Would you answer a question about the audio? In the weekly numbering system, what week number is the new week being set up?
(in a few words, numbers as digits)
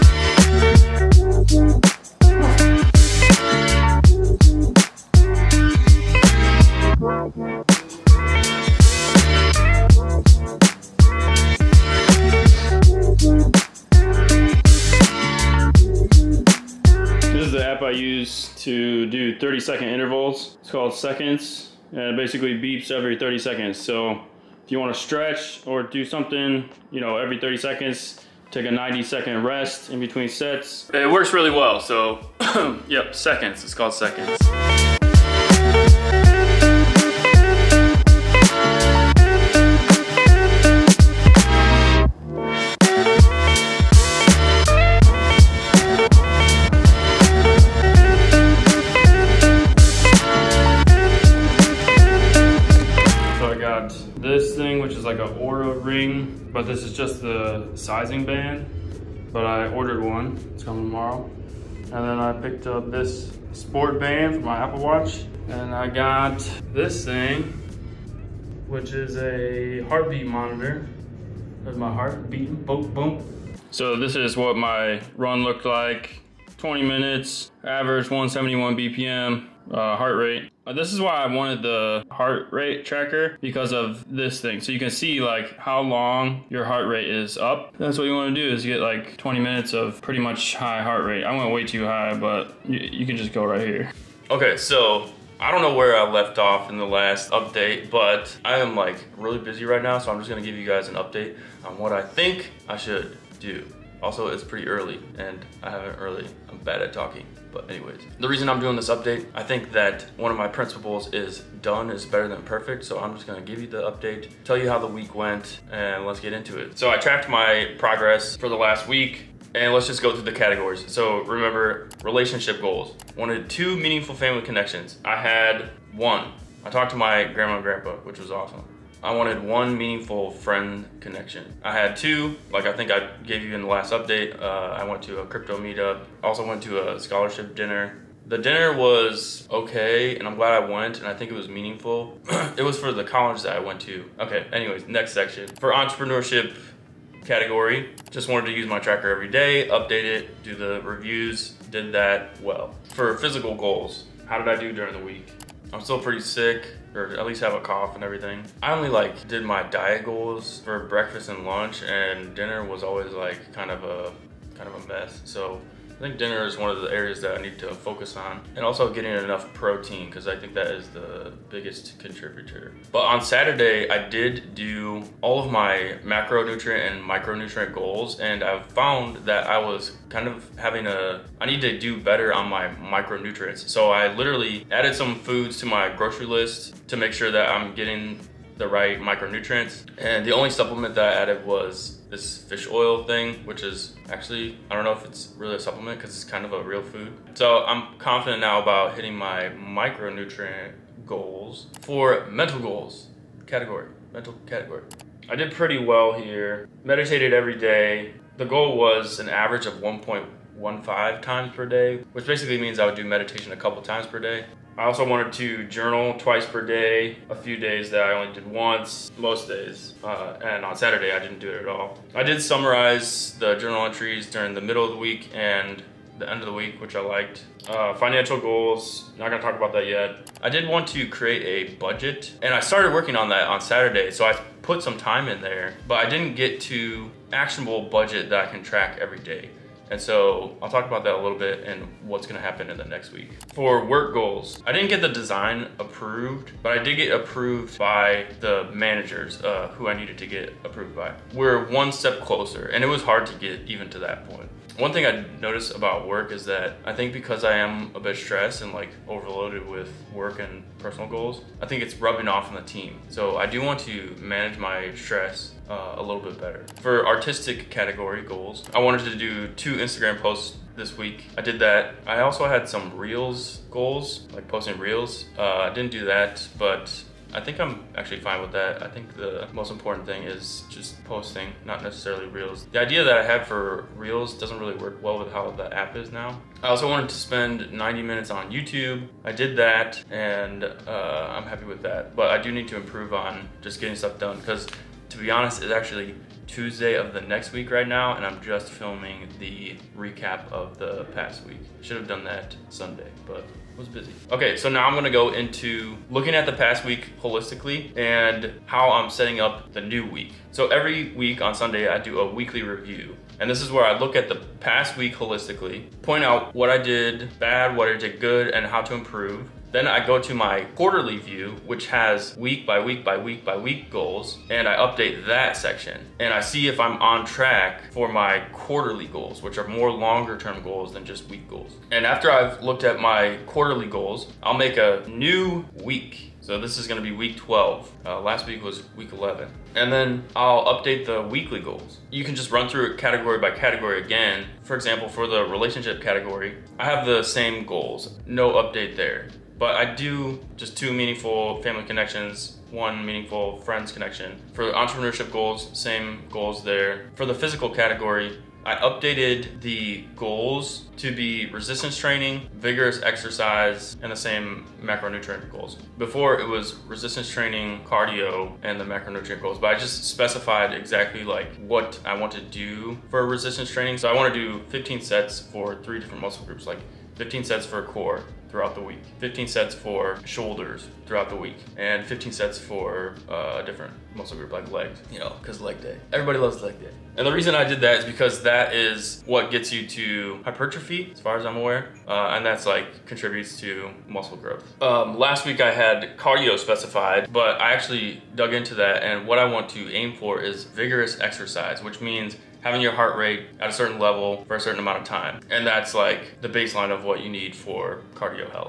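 12.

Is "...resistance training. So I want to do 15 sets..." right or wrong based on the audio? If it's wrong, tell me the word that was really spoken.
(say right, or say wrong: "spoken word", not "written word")
right.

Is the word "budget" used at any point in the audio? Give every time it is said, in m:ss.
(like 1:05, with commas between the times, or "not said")
3:51, 3:57.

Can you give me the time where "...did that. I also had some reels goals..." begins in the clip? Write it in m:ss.
4:31.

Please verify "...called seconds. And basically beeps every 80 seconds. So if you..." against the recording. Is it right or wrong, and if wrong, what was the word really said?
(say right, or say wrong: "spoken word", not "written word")
wrong: "30", not "80".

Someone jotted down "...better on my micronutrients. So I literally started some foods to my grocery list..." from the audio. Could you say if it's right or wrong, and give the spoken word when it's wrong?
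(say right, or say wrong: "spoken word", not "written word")
wrong: "added", not "started".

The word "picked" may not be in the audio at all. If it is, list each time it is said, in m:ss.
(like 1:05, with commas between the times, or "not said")
1:02.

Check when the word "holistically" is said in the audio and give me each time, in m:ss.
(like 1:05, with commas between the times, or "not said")
5:07, 5:15.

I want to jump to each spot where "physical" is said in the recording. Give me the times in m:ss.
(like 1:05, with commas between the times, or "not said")
2:33, 5:57.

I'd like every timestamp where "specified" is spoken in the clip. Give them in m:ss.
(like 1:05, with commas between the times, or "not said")
6:10, 6:36.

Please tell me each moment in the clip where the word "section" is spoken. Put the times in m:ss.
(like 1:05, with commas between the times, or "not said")
2:25, 5:25.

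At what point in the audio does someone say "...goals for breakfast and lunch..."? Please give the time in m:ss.
2:40.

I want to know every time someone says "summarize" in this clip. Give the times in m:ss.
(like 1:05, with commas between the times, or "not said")
3:42.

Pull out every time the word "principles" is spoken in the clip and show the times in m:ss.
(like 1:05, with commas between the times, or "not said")
1:50.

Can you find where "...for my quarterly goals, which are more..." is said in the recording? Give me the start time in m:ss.
5:27.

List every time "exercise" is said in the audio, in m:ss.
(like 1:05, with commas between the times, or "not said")
6:03, 6:41.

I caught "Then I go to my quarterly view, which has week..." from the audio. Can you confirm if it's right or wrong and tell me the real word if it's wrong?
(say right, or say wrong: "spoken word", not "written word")
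right.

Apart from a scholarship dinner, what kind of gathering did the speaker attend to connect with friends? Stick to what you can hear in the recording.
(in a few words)
crypto meetup.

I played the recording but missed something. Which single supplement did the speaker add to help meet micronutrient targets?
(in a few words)
fish oil.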